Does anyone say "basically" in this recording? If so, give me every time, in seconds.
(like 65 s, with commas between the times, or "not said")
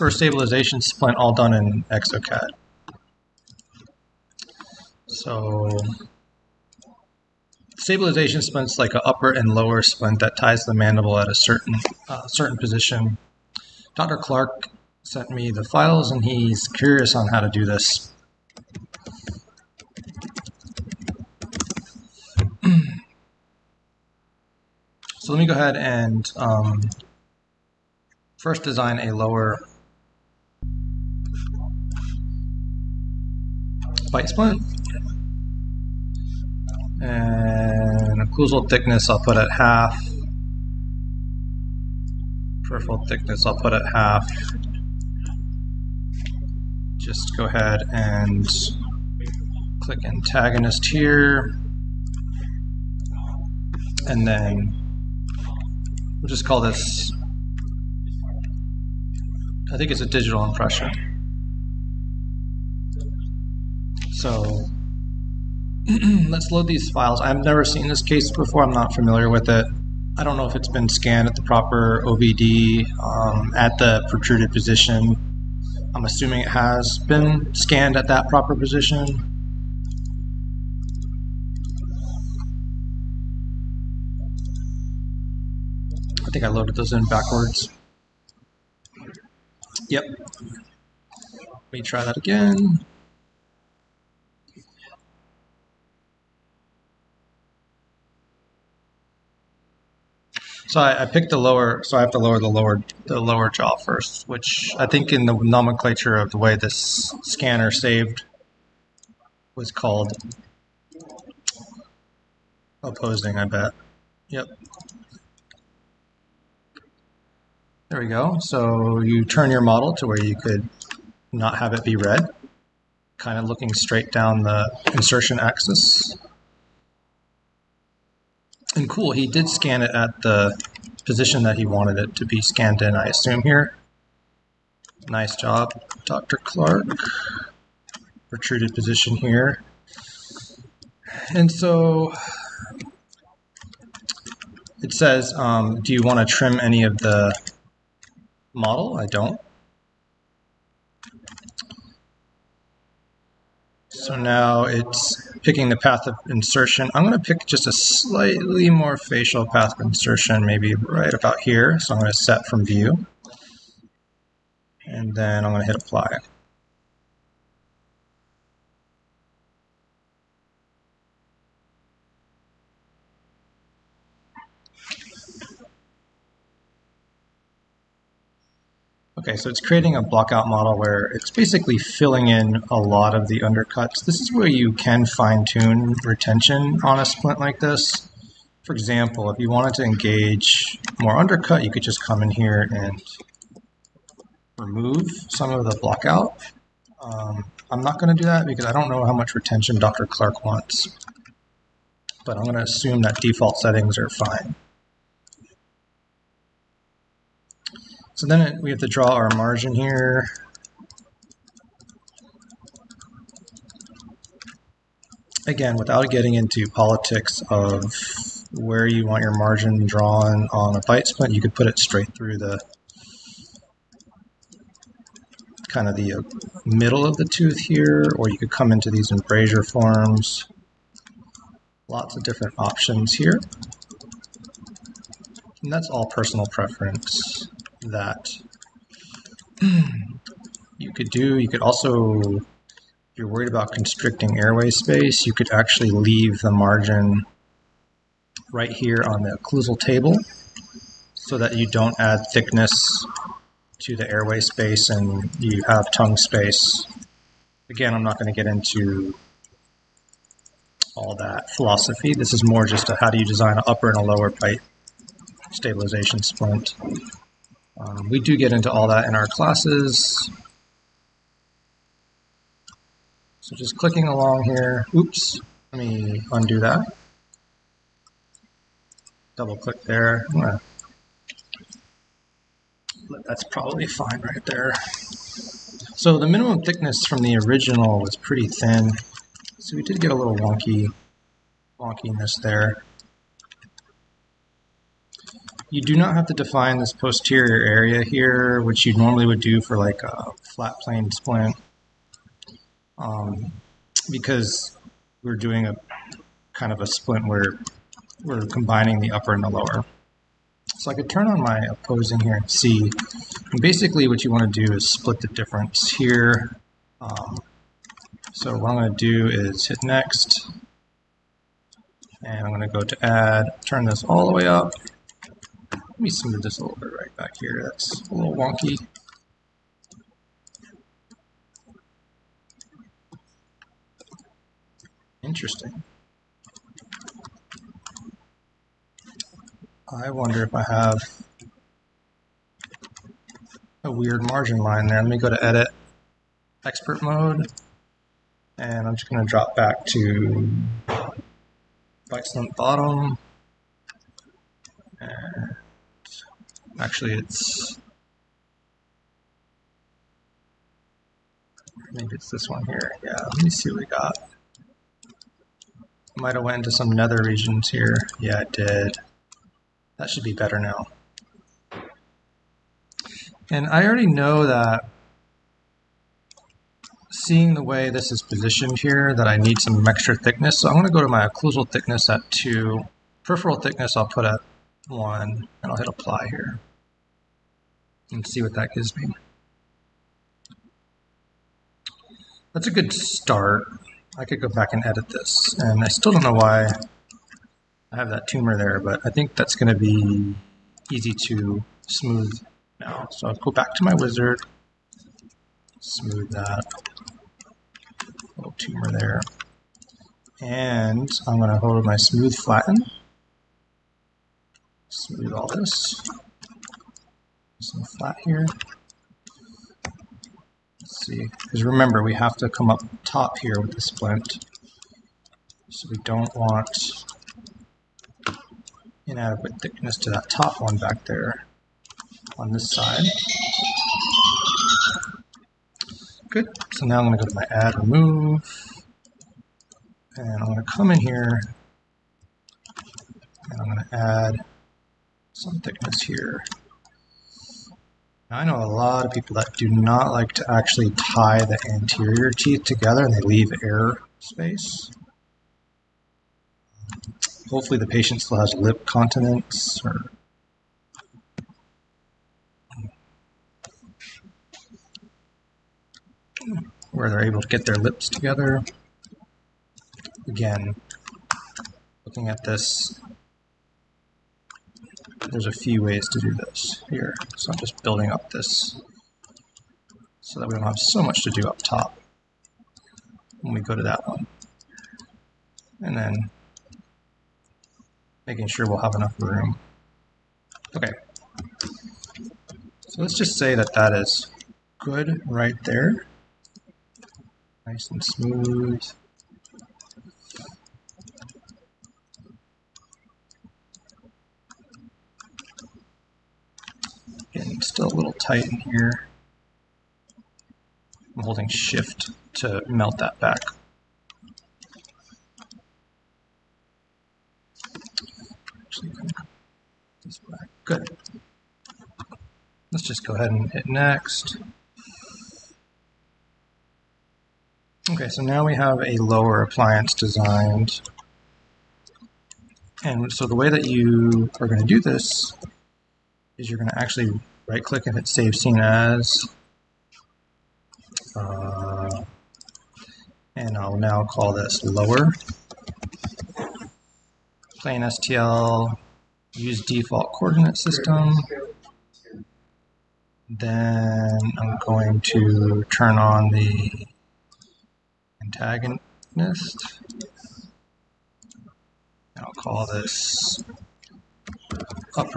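181 s, 313 s.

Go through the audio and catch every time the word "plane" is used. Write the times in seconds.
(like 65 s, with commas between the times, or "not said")
300 s.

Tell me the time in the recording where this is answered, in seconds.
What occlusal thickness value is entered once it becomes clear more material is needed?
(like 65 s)
382 s.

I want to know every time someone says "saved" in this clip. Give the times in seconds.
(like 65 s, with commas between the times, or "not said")
107 s, 538 s.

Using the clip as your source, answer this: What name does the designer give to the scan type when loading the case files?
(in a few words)
digital impression.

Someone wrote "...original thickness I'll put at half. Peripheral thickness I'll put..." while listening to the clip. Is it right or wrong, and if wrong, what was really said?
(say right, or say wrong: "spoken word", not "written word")
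wrong: "occlusal", not "original".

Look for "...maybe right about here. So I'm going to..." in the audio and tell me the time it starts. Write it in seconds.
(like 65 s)
160 s.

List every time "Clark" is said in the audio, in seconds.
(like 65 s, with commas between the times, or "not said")
14 s, 136 s, 200 s.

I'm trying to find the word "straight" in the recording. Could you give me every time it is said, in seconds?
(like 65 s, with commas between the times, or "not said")
123 s, 221 s.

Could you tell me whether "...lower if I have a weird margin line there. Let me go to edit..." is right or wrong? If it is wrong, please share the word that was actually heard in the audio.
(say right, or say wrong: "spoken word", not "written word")
wrong: "wonder", not "lower".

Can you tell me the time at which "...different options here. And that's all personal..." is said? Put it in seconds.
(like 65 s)
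232 s.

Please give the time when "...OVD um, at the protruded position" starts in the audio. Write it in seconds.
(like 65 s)
72 s.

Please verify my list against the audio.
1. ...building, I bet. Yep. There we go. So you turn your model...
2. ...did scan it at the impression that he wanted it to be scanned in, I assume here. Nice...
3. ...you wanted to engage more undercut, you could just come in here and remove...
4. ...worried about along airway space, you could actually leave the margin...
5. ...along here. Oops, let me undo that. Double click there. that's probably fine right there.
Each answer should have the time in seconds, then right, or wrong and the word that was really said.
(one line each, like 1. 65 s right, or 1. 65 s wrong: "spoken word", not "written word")
1. 112 s wrong: "opposing", not "building"
2. 129 s wrong: "position", not "impression"
3. 189 s right
4. 243 s wrong: "constricting", not "along"
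5. 274 s right.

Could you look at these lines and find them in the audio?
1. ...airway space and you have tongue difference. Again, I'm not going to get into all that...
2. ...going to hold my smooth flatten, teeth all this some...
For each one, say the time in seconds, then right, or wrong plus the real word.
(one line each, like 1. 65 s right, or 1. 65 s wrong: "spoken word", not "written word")
1. 254 s wrong: "space", not "difference"
2. 411 s wrong: "smooth", not "teeth".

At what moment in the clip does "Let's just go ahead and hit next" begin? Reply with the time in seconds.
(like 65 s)
522 s.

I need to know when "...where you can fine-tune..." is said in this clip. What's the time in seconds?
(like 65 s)
184 s.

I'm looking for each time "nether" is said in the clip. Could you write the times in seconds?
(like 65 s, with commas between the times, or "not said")
366 s.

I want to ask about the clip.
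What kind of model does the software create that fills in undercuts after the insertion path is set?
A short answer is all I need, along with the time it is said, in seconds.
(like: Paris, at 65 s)
blockout model, at 180 s.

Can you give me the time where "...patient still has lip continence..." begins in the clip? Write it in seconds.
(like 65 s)
457 s.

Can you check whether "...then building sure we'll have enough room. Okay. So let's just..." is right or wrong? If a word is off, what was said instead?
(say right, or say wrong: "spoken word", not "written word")
wrong: "making", not "building".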